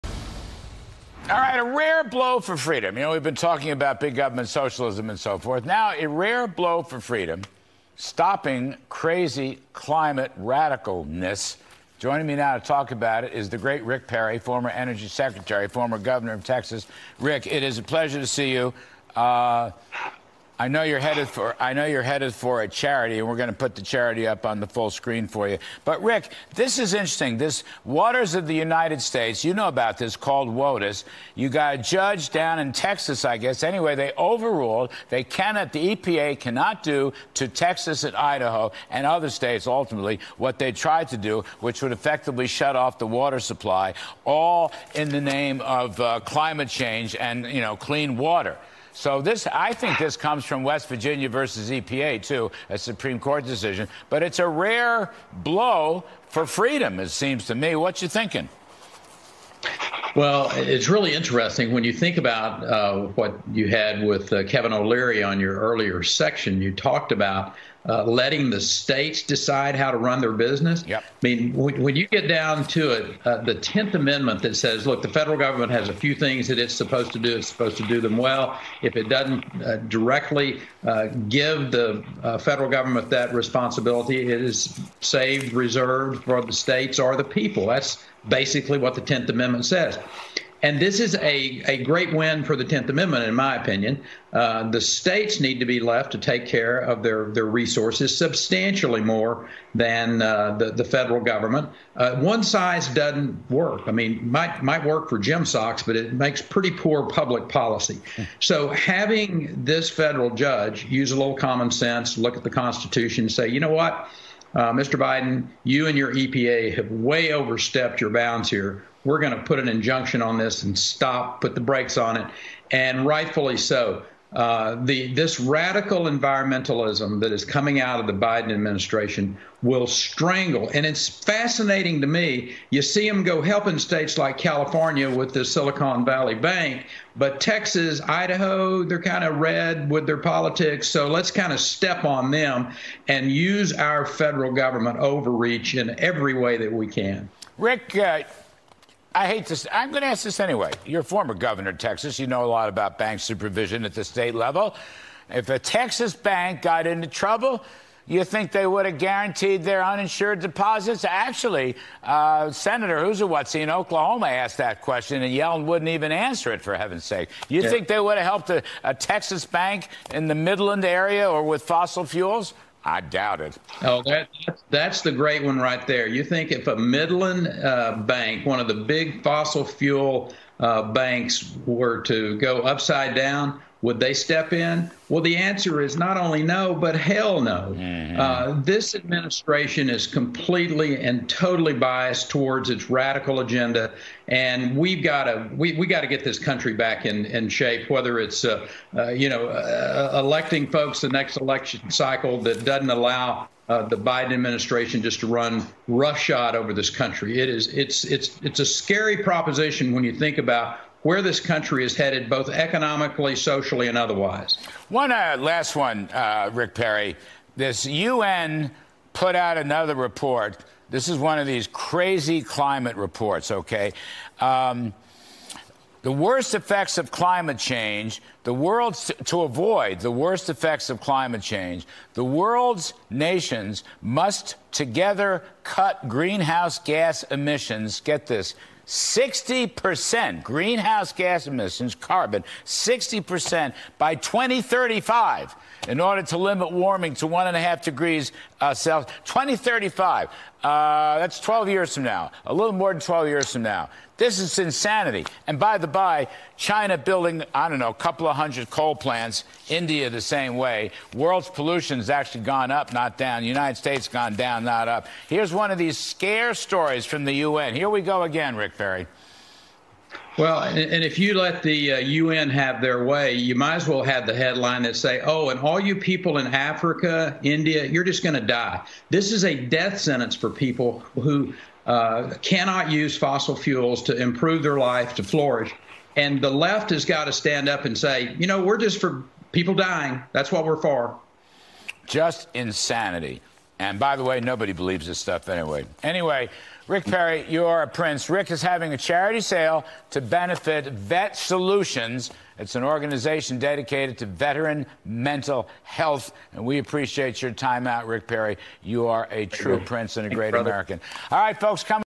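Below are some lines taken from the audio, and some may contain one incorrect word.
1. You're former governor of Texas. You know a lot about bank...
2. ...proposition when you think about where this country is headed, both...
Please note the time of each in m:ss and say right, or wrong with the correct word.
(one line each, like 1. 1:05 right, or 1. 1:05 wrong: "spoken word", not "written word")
1. 2:30 right
2. 3:29 right.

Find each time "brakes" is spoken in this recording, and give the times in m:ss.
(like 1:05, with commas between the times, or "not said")
2:01.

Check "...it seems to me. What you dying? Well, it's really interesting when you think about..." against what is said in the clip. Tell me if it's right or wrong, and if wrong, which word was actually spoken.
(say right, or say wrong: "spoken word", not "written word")
wrong: "thinking", not "dying".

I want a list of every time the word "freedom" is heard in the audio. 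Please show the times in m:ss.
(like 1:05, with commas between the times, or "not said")
0:02, 0:06, 0:56.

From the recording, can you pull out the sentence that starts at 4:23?
United States gone down, not up.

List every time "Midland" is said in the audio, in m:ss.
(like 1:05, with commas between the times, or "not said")
2:50, 2:56.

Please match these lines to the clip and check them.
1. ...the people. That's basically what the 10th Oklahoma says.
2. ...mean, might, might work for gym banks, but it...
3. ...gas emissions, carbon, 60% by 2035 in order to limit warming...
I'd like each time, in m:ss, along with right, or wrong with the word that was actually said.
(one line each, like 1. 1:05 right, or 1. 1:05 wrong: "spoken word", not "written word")
1. 1:27 wrong: "Amendment", not "Oklahoma"
2. 1:43 wrong: "socks", not "banks"
3. 4:01 right.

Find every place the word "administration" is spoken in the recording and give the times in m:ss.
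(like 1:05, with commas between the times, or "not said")
2:08, 3:08, 3:24.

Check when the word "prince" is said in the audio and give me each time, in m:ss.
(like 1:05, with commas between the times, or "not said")
4:57, 5:09.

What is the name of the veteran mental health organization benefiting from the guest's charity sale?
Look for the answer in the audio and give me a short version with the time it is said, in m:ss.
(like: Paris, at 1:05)
Vet Solutions, at 5:00.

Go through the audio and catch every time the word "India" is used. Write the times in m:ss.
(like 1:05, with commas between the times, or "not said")
4:19, 4:37.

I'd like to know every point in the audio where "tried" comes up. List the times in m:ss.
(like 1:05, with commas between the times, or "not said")
0:40.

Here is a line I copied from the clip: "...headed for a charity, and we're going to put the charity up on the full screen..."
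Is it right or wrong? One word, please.
right.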